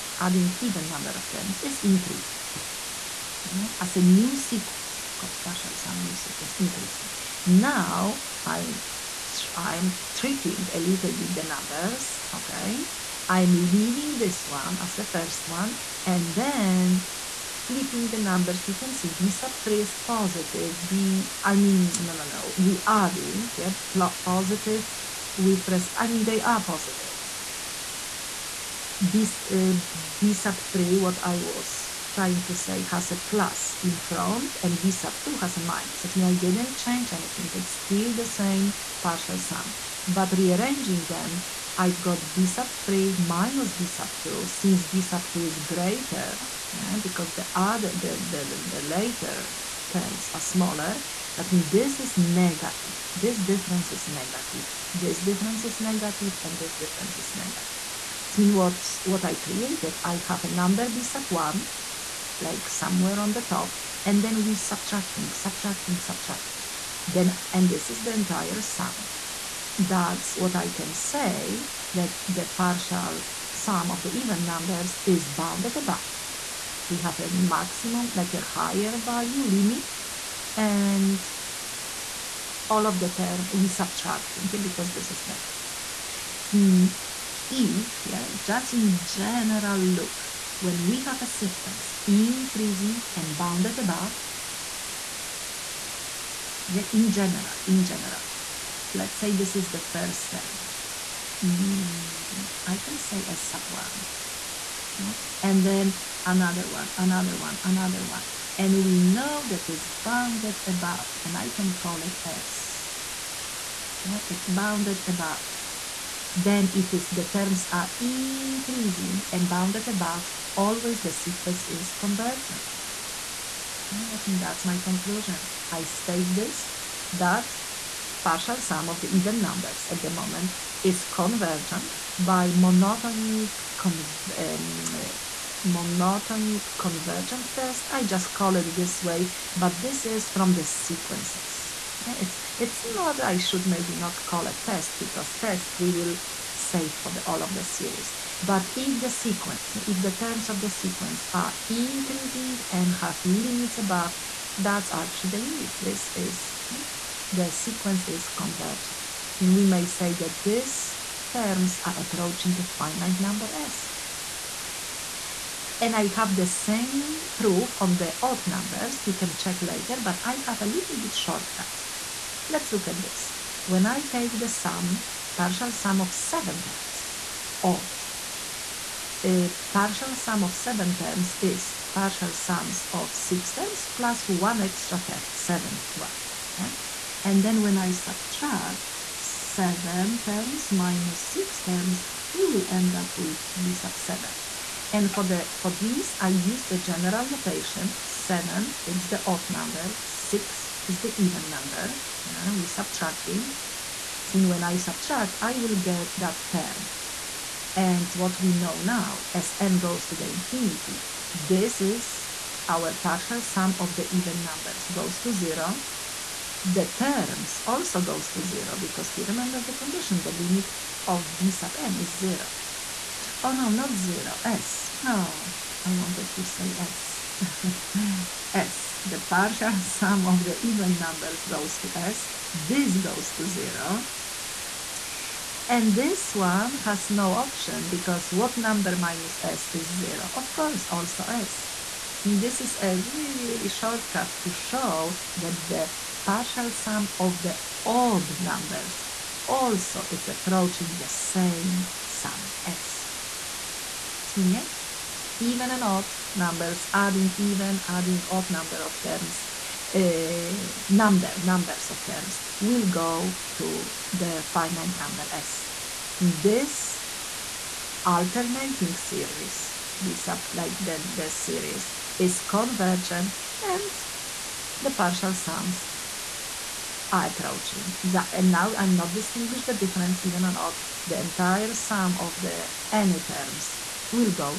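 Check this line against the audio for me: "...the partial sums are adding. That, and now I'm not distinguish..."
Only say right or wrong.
wrong.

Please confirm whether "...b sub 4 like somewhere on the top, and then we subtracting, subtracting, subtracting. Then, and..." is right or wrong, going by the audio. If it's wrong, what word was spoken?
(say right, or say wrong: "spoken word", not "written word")
wrong: "1", not "4".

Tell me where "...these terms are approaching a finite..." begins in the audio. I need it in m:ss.
2:40.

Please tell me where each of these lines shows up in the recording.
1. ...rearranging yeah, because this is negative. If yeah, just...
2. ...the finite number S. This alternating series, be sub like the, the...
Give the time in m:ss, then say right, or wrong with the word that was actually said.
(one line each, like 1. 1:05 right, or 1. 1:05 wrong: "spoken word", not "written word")
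1. 1:23 wrong: "subtracting", not "rearranging"
2. 4:24 right.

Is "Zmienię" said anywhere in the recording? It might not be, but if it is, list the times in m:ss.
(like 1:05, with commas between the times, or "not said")
4:14.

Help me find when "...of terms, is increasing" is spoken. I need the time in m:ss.
0:01.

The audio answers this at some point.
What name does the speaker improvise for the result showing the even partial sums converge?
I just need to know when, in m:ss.
2:15.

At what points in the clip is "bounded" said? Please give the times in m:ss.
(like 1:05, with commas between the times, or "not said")
1:15, 1:33, 1:50, 1:54, 1:59.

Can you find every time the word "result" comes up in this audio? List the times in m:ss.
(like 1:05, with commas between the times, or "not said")
not said.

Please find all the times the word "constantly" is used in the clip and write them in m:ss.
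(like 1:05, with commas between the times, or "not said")
not said.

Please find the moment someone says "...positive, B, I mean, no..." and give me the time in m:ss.
0:19.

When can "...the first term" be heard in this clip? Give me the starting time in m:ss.
1:39.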